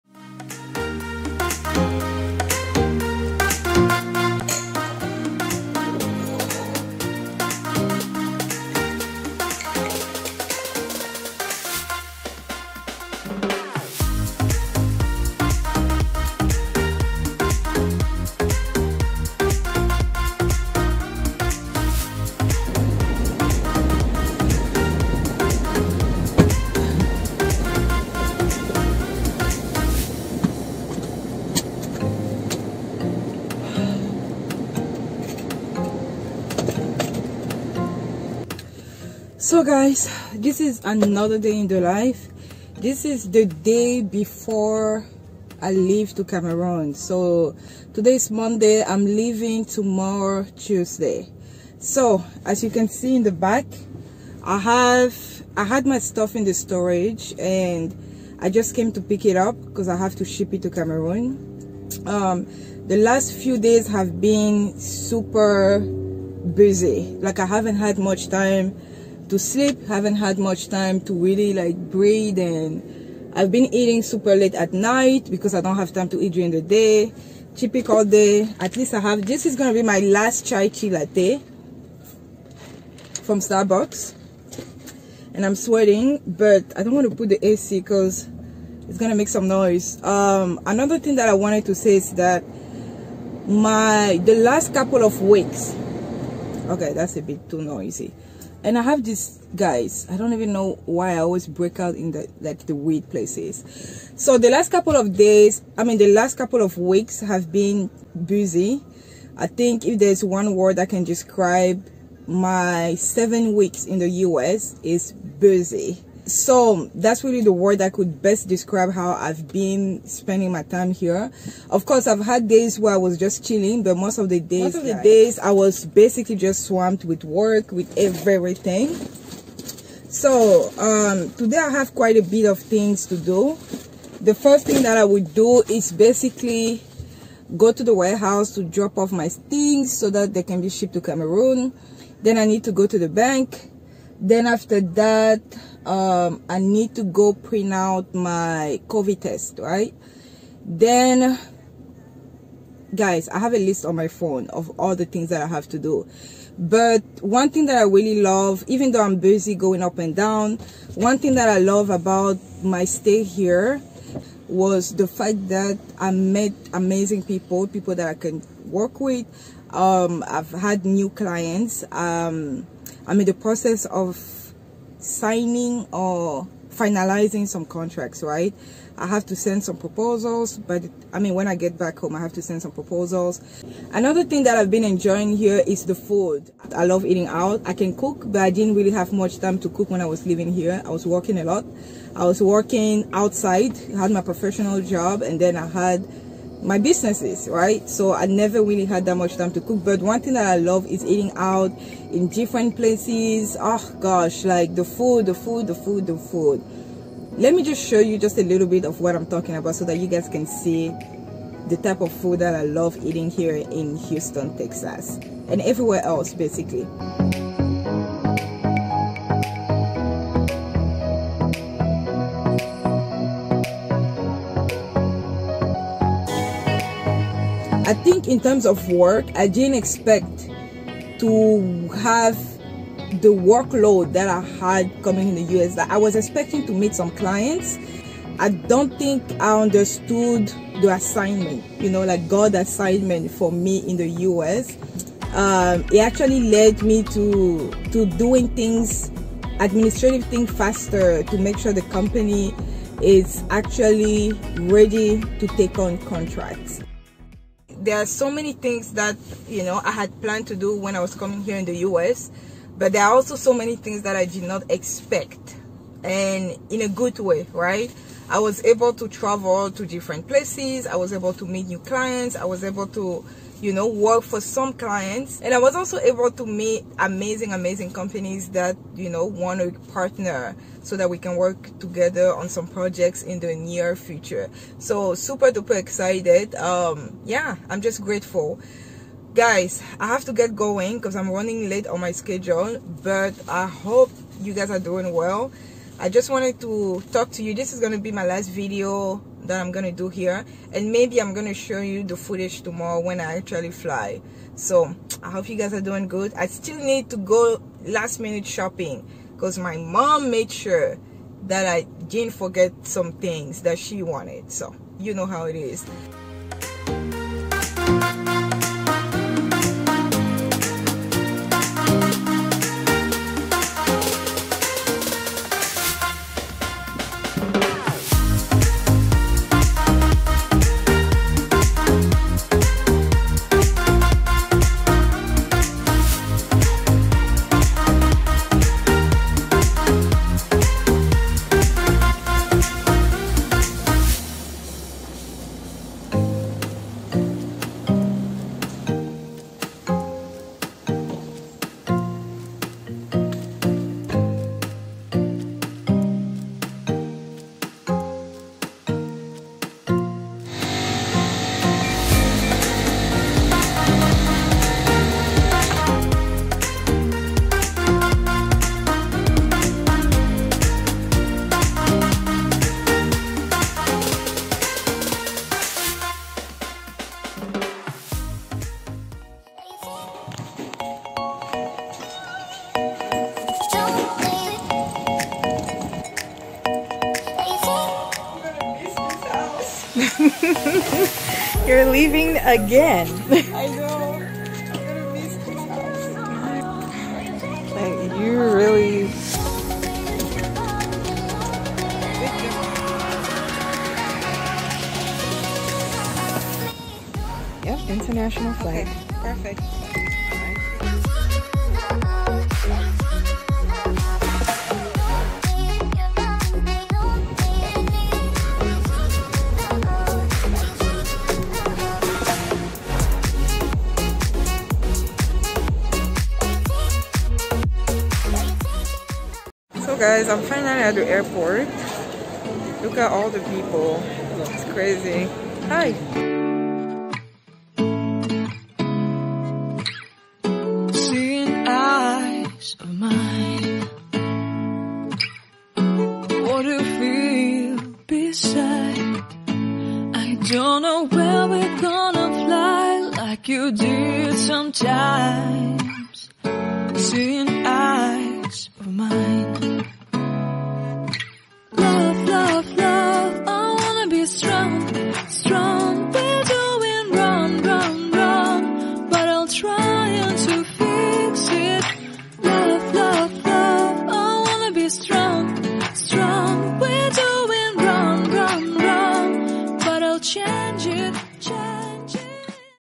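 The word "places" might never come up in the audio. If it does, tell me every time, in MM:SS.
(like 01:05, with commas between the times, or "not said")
01:43, 03:22, 04:30.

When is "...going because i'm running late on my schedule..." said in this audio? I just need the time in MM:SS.
04:50.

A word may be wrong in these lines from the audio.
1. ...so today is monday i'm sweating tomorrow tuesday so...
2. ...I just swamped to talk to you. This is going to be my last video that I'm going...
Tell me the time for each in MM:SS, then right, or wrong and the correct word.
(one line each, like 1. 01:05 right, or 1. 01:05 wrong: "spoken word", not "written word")
1. 00:46 wrong: "leaving", not "sweating"
2. 04:56 wrong: "wanted", not "swamped".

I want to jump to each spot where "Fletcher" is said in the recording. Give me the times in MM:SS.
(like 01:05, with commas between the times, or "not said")
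not said.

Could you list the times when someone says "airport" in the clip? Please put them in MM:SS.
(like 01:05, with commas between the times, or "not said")
07:11.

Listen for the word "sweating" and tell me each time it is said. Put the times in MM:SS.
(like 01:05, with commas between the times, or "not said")
01:25.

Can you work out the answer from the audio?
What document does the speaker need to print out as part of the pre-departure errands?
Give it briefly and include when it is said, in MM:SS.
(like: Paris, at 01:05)
covid test, at 02:28.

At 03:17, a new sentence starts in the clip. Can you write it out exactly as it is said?
So I never really had that much time to cook.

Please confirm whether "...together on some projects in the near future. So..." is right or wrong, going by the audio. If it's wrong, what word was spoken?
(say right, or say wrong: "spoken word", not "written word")
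right.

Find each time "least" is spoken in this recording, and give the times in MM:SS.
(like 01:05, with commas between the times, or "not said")
01:18.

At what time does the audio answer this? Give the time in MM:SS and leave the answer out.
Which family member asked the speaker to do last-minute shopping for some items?
05:09.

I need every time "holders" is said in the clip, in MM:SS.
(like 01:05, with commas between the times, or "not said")
not said.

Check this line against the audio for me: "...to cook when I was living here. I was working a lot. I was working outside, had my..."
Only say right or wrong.
right.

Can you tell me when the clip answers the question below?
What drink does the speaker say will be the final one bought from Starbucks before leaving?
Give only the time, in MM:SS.
01:20.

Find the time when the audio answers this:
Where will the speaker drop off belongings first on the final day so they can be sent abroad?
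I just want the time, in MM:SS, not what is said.
02:17.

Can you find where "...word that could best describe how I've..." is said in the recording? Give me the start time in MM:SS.
01:57.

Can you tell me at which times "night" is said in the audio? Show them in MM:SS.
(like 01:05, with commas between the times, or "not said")
01:14.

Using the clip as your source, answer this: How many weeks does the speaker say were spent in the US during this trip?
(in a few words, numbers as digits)
7.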